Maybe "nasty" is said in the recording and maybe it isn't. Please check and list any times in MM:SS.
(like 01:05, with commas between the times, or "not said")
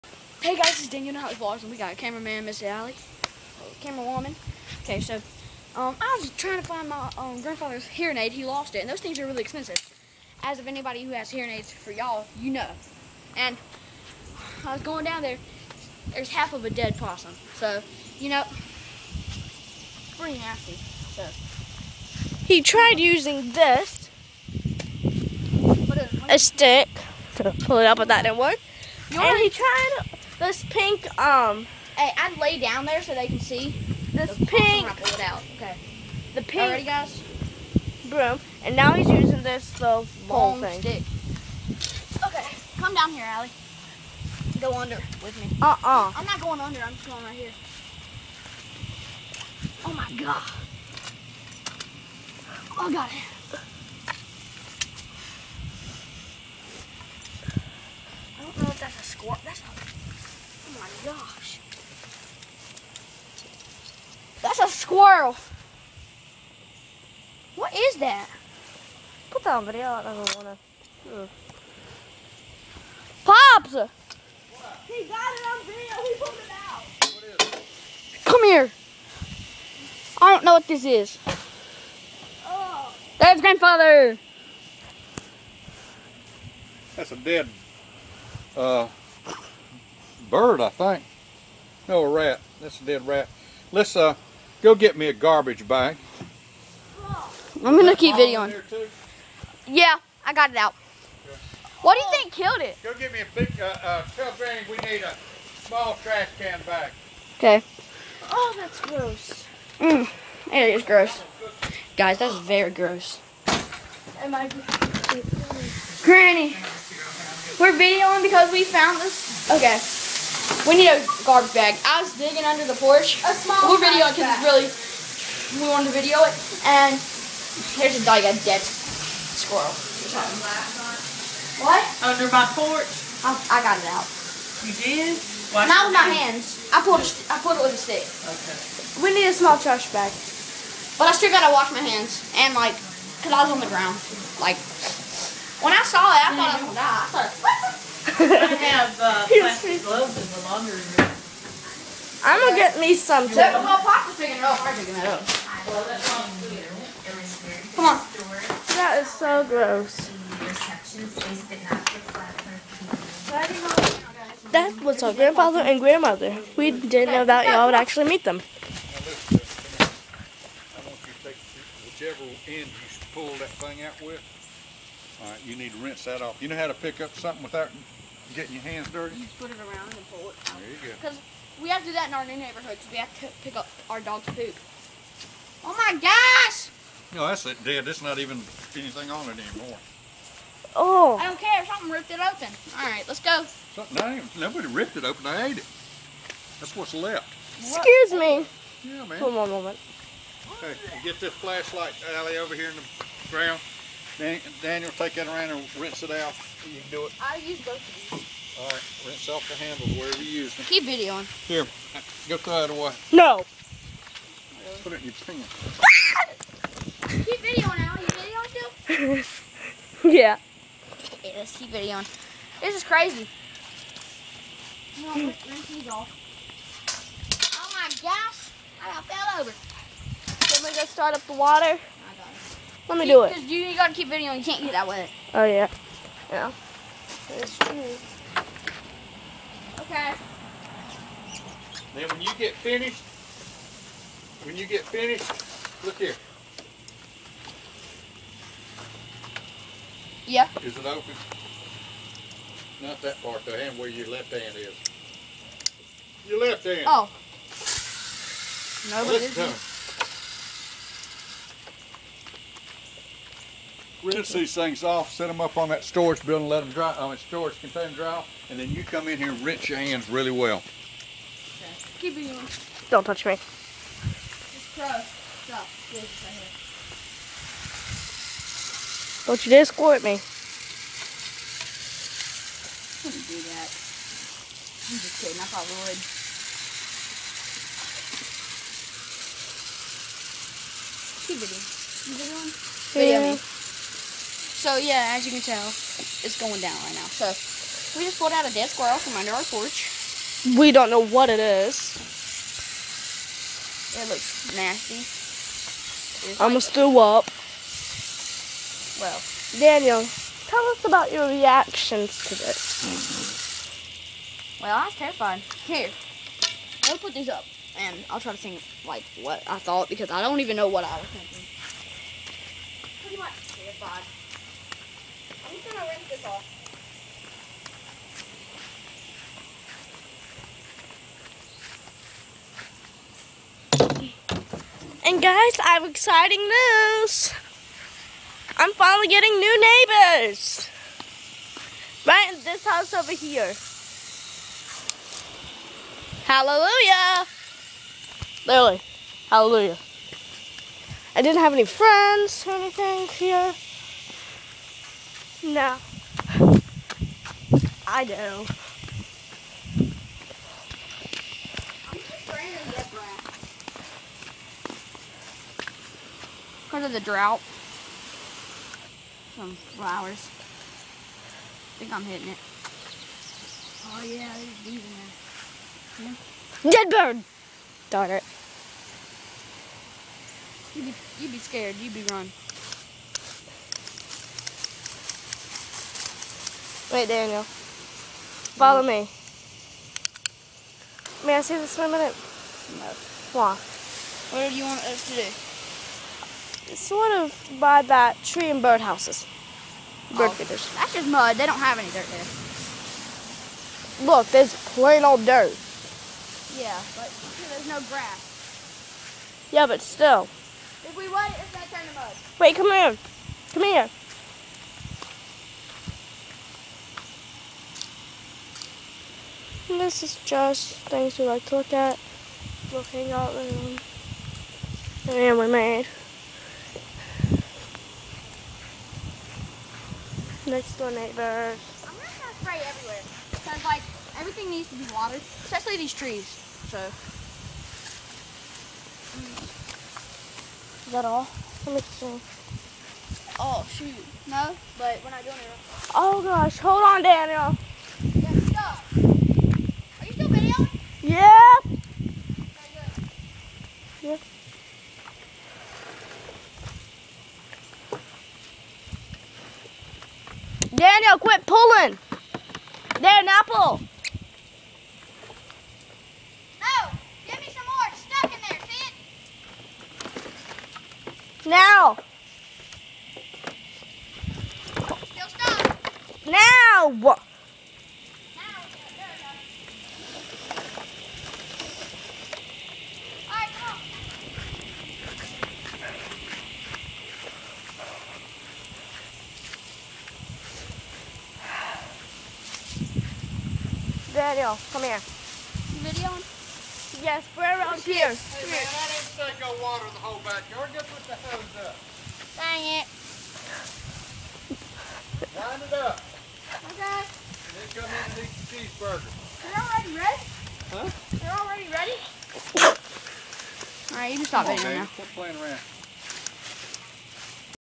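00:20, 05:04.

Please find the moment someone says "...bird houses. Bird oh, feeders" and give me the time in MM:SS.
06:38.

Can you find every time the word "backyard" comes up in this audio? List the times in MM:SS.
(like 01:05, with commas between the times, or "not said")
08:20.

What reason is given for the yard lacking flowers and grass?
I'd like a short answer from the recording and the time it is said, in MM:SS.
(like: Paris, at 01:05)
The drought, at 06:06.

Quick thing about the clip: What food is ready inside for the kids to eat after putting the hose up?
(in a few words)
Cheeseburger.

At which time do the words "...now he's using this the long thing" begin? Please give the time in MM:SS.
00:38.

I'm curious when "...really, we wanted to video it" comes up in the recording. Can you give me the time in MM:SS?
02:04.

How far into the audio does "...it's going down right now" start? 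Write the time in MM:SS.
04:55.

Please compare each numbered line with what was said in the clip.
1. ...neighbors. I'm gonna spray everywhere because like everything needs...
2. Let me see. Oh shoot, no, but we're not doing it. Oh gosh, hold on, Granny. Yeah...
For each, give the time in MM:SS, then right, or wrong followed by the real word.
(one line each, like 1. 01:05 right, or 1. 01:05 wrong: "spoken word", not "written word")
1. 07:10 right
2. 07:21 wrong: "Daniel", not "Granny".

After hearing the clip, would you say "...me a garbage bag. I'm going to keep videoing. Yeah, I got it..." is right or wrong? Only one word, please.
right.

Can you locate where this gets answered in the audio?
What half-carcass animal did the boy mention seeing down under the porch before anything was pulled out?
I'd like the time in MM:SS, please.
00:16.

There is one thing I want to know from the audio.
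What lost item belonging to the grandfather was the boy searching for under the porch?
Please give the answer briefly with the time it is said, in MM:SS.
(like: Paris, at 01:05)
Hearing aid, at 00:07.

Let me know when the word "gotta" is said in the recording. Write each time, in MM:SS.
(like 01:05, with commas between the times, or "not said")
02:21, 03:53.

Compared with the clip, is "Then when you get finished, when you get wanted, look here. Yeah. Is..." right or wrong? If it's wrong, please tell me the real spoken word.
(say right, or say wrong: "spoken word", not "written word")
wrong: "finished", not "wanted".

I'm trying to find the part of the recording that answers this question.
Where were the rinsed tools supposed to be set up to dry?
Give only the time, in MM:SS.
04:25.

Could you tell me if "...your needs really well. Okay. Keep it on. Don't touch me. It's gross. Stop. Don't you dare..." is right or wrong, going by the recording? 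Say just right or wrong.
wrong.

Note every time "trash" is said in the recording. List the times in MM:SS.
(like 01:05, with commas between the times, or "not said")
01:46, 02:19.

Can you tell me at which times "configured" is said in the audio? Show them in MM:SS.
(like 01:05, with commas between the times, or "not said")
not said.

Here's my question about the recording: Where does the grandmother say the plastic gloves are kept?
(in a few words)
Laundry room.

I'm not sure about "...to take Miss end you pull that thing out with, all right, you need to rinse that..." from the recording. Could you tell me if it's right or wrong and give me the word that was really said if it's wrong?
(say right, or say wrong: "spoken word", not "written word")
wrong: "Whichever", not "Miss".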